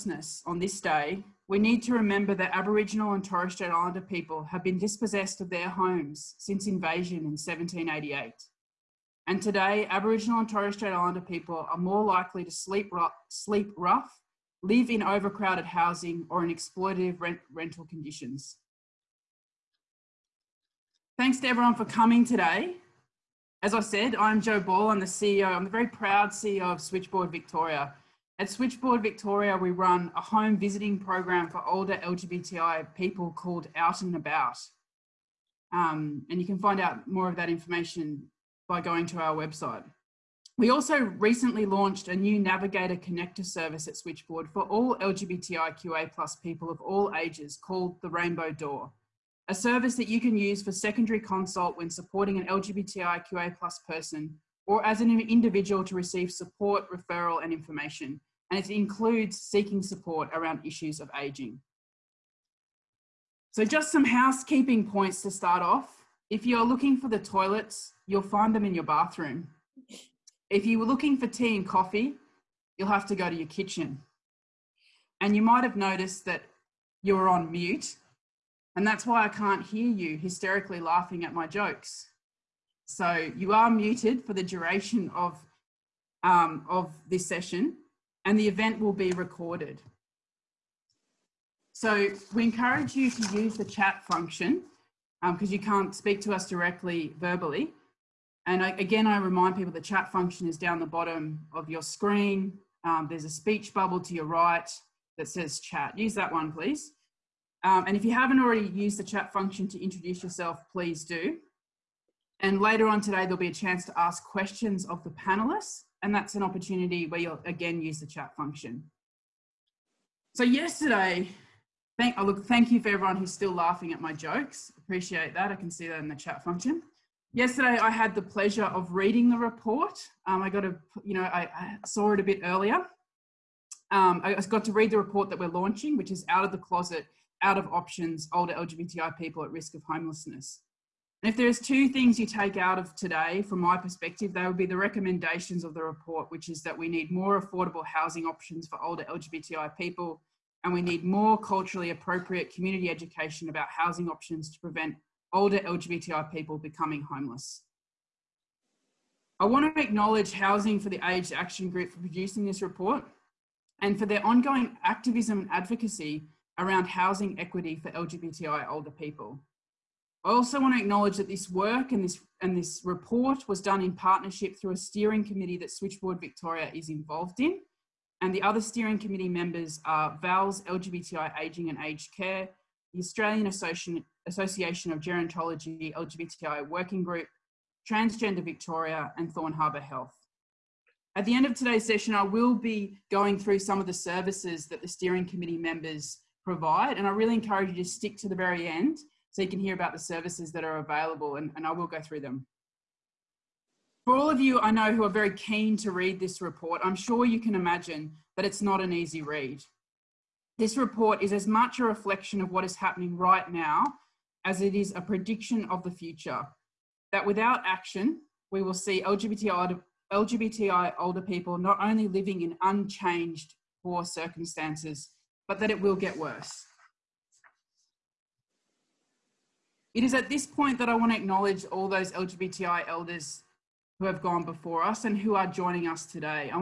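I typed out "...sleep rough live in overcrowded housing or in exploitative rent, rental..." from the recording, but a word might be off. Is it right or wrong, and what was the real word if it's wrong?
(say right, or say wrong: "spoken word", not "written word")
right.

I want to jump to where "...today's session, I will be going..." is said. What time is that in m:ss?
3:11.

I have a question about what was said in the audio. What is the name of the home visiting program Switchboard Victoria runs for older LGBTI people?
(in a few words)
Out and About.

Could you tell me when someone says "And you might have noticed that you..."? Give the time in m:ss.
1:15.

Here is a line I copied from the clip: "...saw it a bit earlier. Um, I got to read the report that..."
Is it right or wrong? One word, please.
right.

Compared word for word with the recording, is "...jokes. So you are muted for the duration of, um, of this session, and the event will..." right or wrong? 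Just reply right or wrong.
right.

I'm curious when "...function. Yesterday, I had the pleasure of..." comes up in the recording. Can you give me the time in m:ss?
2:06.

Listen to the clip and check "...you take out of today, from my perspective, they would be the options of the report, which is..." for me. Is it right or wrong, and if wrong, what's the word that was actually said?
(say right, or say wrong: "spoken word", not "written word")
wrong: "recommendations", not "options".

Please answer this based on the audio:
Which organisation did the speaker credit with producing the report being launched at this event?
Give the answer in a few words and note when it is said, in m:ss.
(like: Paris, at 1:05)
Housing for the Aged Action Group, at 2:40.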